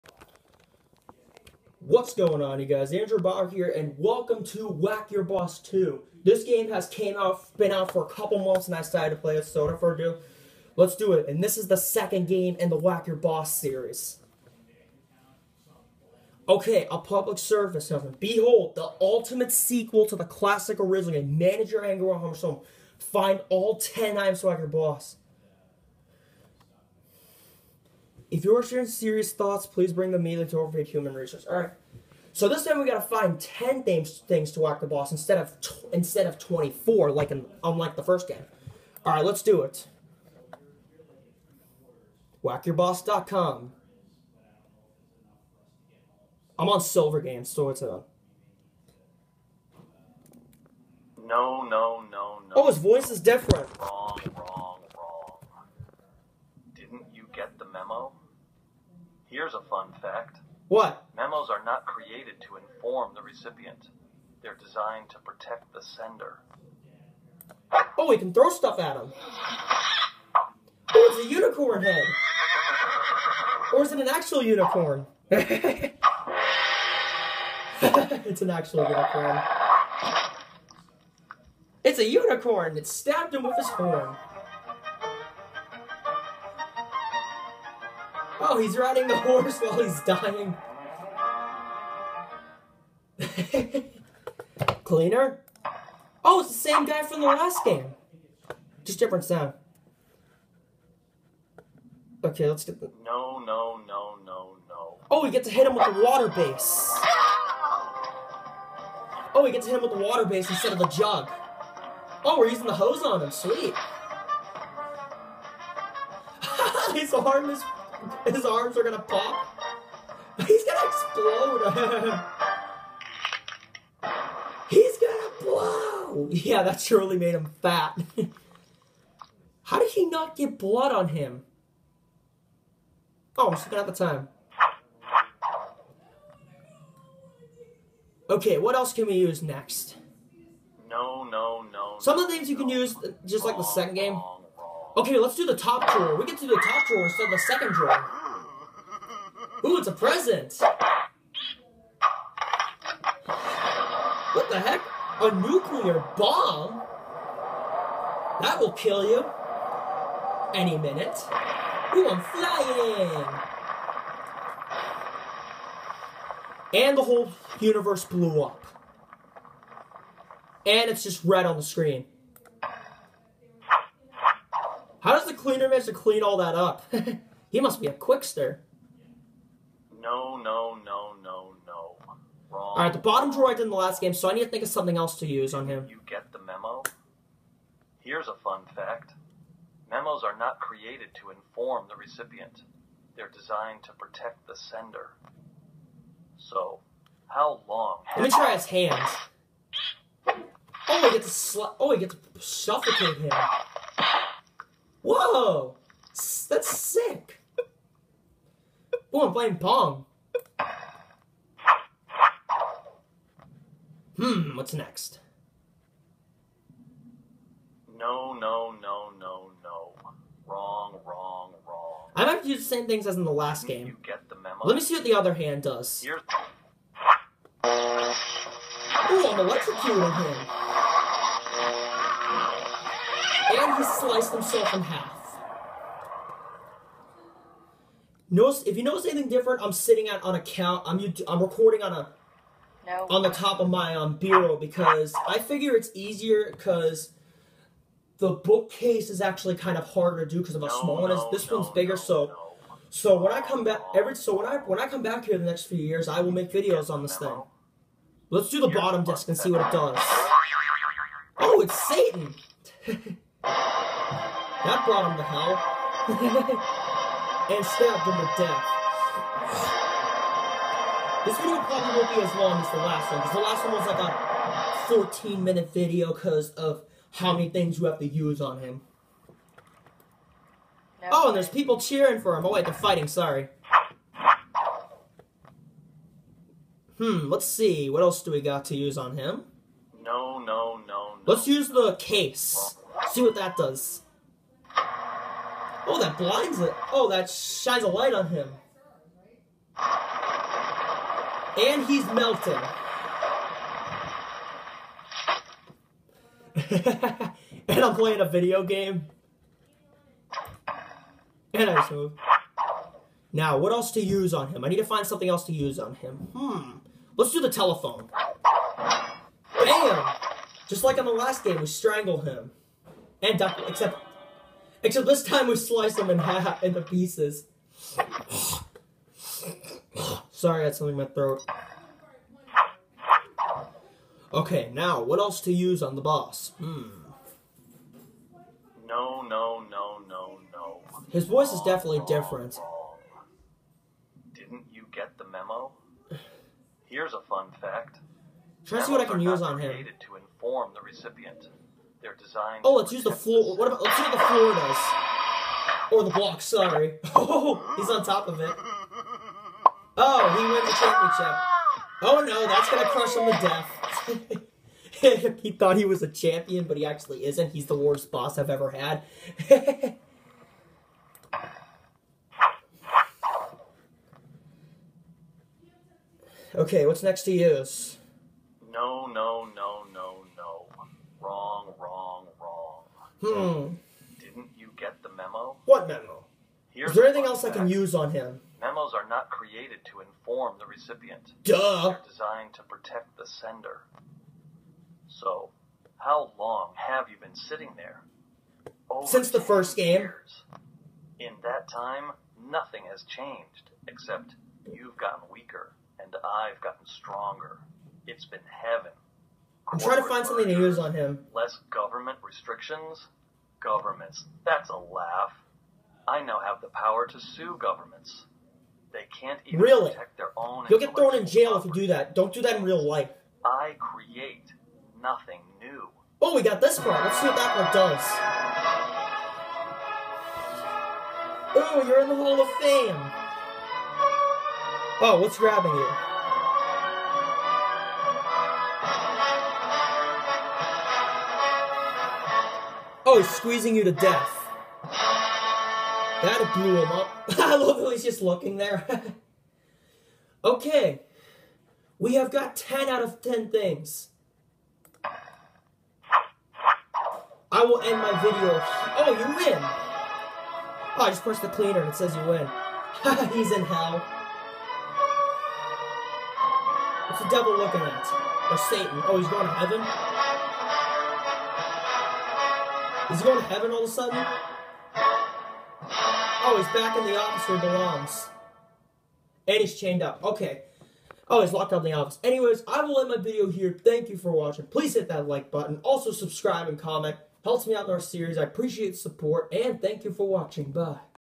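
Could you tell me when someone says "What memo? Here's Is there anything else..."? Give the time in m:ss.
6:25.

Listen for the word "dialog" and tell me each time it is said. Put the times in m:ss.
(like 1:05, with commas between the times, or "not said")
not said.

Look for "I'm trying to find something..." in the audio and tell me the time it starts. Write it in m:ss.
6:49.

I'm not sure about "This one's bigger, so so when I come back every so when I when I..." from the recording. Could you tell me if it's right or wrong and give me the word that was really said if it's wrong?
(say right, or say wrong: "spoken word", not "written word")
right.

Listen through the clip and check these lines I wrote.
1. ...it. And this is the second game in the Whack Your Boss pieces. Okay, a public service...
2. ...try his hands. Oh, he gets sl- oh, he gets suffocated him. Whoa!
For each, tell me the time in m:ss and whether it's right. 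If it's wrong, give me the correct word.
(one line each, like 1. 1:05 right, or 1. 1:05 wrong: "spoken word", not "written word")
1. 0:11 wrong: "series", not "pieces"
2. 3:18 right.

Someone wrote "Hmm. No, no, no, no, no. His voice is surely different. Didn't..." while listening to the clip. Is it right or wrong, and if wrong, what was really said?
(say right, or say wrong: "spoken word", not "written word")
wrong: "definitely", not "surely".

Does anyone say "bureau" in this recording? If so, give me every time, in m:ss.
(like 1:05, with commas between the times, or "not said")
4:04.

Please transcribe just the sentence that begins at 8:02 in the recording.
Anyways, I will end my video here.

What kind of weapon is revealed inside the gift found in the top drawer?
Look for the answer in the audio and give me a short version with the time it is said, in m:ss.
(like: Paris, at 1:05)
nuclear bomb, at 2:35.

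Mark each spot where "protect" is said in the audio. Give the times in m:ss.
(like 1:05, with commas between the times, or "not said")
1:05, 3:13, 6:32, 6:59.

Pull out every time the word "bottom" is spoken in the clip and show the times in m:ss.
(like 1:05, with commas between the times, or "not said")
3:02, 4:18.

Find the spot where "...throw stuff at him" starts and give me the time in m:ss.
1:08.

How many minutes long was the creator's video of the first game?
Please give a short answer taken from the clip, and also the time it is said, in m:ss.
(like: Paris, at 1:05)
14, at 4:35.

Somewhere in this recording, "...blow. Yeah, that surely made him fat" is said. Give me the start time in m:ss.
2:05.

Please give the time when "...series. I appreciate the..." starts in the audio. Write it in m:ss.
8:07.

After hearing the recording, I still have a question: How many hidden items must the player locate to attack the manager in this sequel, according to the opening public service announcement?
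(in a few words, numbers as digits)
10.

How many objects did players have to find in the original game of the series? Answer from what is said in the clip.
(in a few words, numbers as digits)
24.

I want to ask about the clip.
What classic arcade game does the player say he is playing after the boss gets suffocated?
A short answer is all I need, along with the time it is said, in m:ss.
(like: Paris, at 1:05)
Pong, at 3:29.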